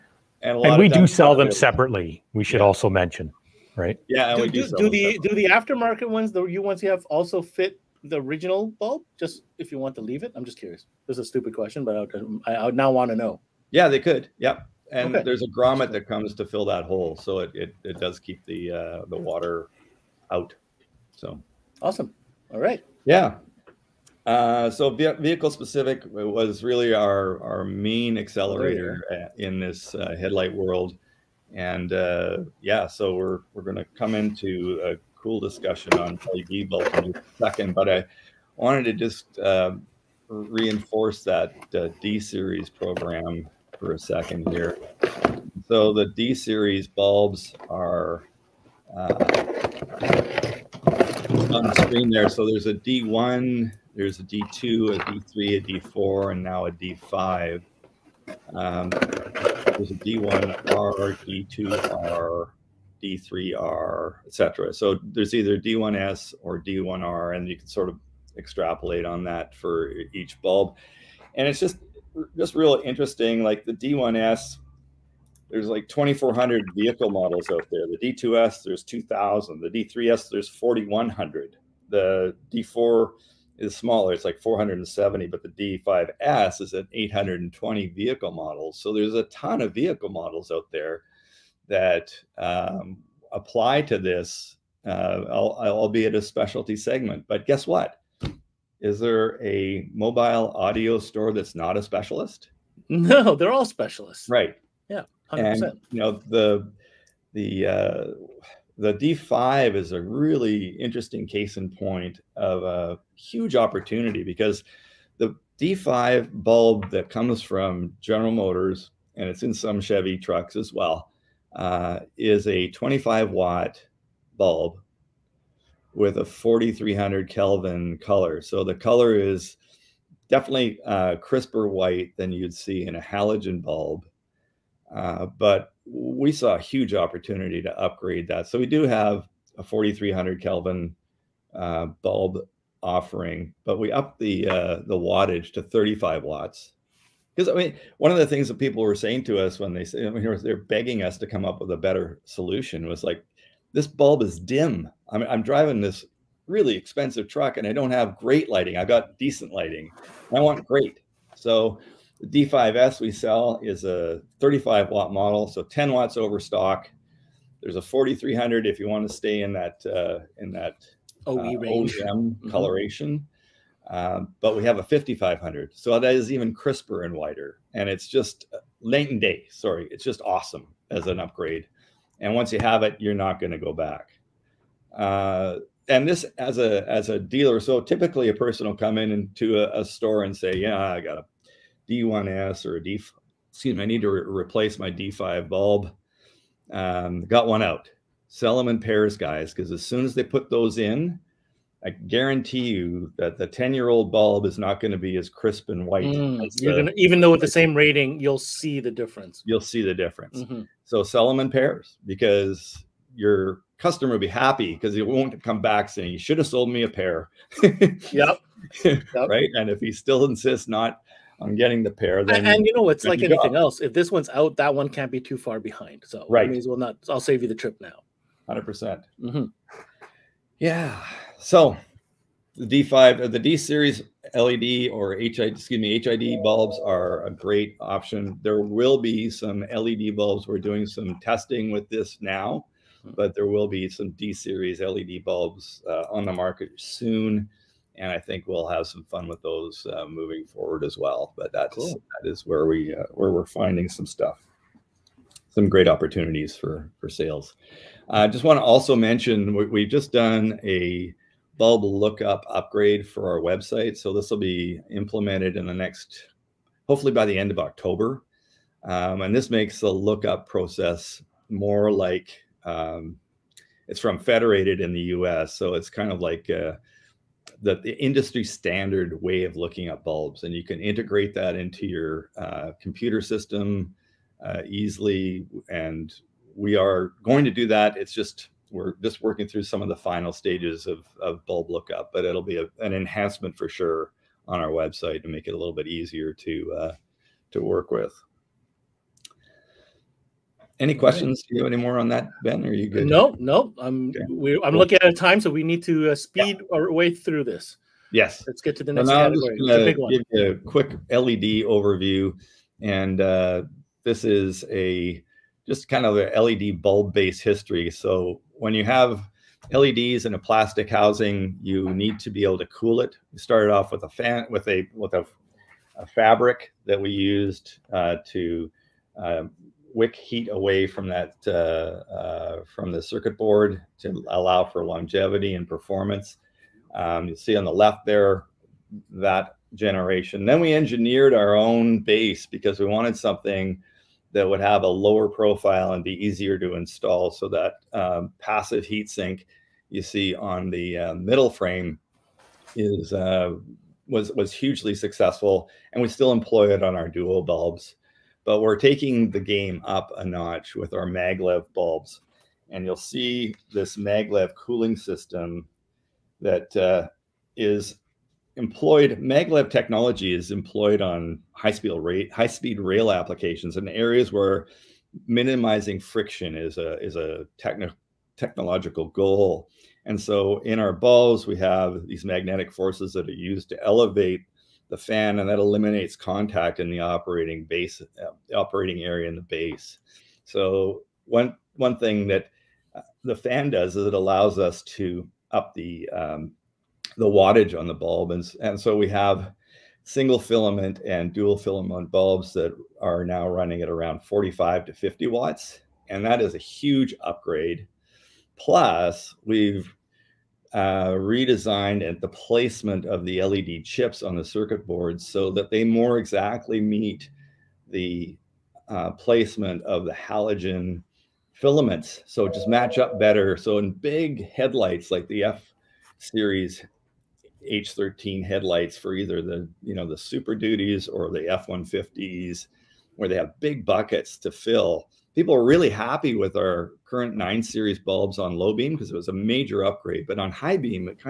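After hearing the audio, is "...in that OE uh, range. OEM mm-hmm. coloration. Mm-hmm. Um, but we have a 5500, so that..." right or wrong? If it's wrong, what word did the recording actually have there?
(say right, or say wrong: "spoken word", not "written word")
right.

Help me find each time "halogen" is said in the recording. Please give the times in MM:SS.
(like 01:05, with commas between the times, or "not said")
02:13, 07:00.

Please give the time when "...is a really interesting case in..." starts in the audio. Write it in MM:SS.
01:49.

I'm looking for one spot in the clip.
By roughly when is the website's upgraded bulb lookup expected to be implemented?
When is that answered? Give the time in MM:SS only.
04:27.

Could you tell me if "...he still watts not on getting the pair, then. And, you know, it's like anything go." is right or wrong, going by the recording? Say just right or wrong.
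wrong.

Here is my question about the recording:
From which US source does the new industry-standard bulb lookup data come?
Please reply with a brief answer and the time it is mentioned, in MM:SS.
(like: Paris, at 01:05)
Federated, at 04:34.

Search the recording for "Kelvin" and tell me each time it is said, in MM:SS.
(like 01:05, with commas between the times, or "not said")
02:07, 02:20.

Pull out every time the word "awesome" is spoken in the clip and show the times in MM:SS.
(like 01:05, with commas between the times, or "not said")
00:21, 03:00.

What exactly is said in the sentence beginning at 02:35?
I'm, I'm driving this really expensive truck and I don't have great lighting.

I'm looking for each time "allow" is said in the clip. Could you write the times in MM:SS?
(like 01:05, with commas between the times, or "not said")
05:34, 06:34.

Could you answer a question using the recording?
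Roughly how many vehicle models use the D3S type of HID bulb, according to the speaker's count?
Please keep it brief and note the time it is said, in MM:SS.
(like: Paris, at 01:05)
4,100, at 01:20.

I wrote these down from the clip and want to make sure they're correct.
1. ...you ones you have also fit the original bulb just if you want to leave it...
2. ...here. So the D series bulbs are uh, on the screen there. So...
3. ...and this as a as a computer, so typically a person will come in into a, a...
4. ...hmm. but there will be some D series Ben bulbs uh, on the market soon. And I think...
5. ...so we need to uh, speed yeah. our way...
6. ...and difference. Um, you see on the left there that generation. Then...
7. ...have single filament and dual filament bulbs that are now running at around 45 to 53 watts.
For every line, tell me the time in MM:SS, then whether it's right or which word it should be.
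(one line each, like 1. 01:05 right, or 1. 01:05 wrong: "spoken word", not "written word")
1. 00:06 right
2. 00:44 right
3. 03:05 wrong: "dealer", not "computer"
4. 04:03 wrong: "LED", not "Ben"
5. 05:05 right
6. 05:35 wrong: "performance", not "difference"
7. 06:39 wrong: "50", not "53".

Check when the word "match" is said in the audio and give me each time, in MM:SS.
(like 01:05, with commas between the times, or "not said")
07:02.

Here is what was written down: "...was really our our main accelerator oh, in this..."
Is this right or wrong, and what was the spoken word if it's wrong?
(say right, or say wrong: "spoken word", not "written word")
right.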